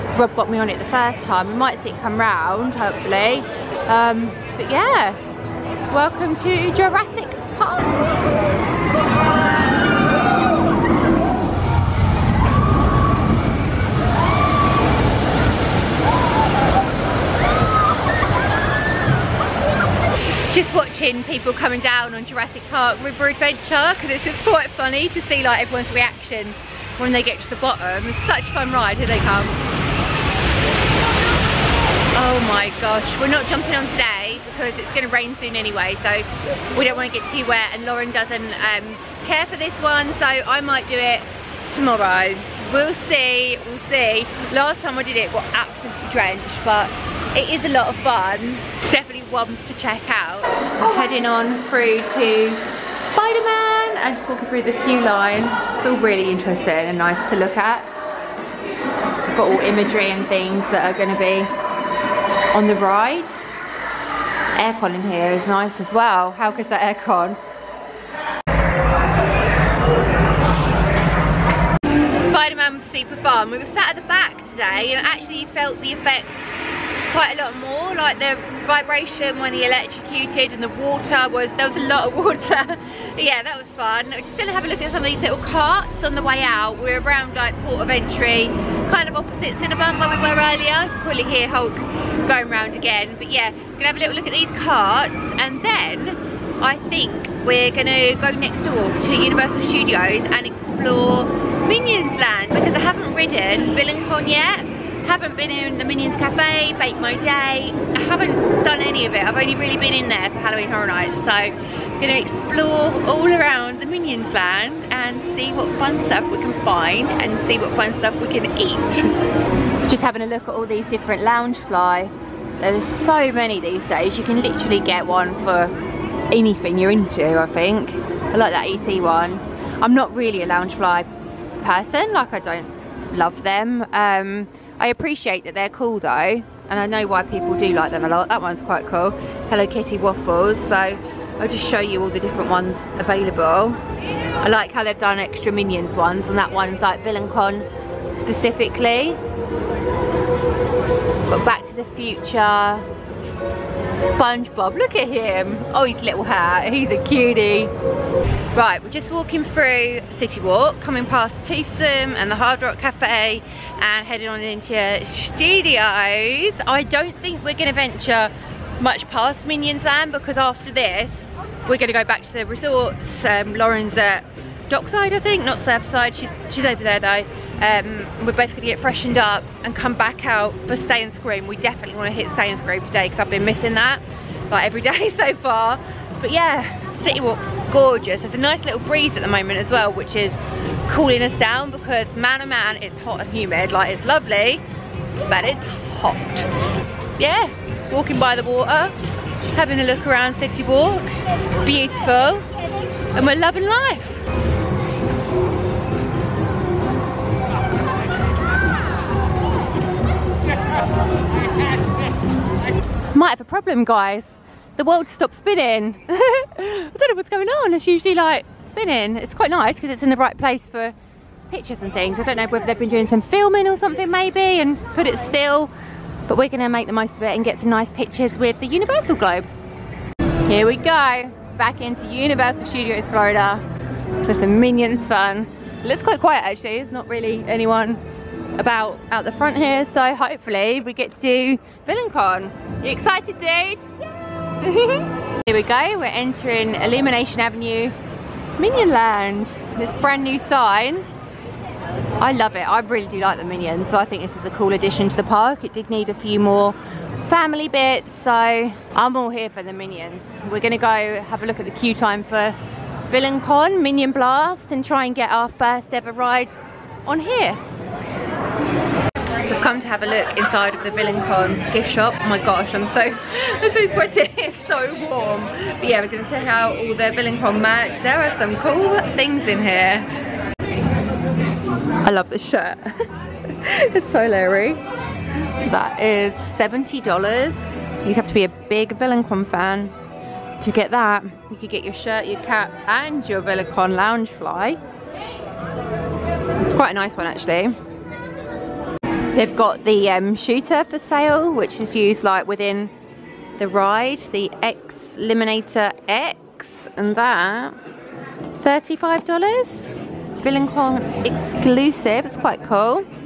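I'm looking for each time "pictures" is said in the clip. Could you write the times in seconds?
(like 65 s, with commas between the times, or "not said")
221 s, 227 s.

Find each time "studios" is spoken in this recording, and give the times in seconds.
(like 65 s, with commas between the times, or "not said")
99 s, 165 s, 232 s.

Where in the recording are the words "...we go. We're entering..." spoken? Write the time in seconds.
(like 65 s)
245 s.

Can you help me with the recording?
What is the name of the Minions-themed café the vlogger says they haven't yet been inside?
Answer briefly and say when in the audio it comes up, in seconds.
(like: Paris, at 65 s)
Bake My Day, at 106 s.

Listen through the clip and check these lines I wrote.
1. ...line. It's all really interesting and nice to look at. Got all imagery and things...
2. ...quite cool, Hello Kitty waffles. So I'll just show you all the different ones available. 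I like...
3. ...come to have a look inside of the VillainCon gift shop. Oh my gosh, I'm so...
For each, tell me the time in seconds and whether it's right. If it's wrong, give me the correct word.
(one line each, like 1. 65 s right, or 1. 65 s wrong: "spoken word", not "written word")
1. 55 s right
2. 138 s right
3. 269 s right.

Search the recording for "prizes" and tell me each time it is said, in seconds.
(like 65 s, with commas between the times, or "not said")
not said.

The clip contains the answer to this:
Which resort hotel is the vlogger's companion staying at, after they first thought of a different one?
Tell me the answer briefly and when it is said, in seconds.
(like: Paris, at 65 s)
Dockside, at 174 s.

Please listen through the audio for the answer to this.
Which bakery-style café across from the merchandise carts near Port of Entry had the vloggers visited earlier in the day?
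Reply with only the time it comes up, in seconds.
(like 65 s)
89 s.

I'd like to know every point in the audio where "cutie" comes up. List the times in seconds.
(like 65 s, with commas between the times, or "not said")
157 s.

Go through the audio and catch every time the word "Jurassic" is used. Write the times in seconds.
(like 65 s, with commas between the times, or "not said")
6 s, 22 s.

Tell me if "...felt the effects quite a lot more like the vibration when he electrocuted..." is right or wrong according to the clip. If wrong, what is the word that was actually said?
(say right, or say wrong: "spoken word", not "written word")
right.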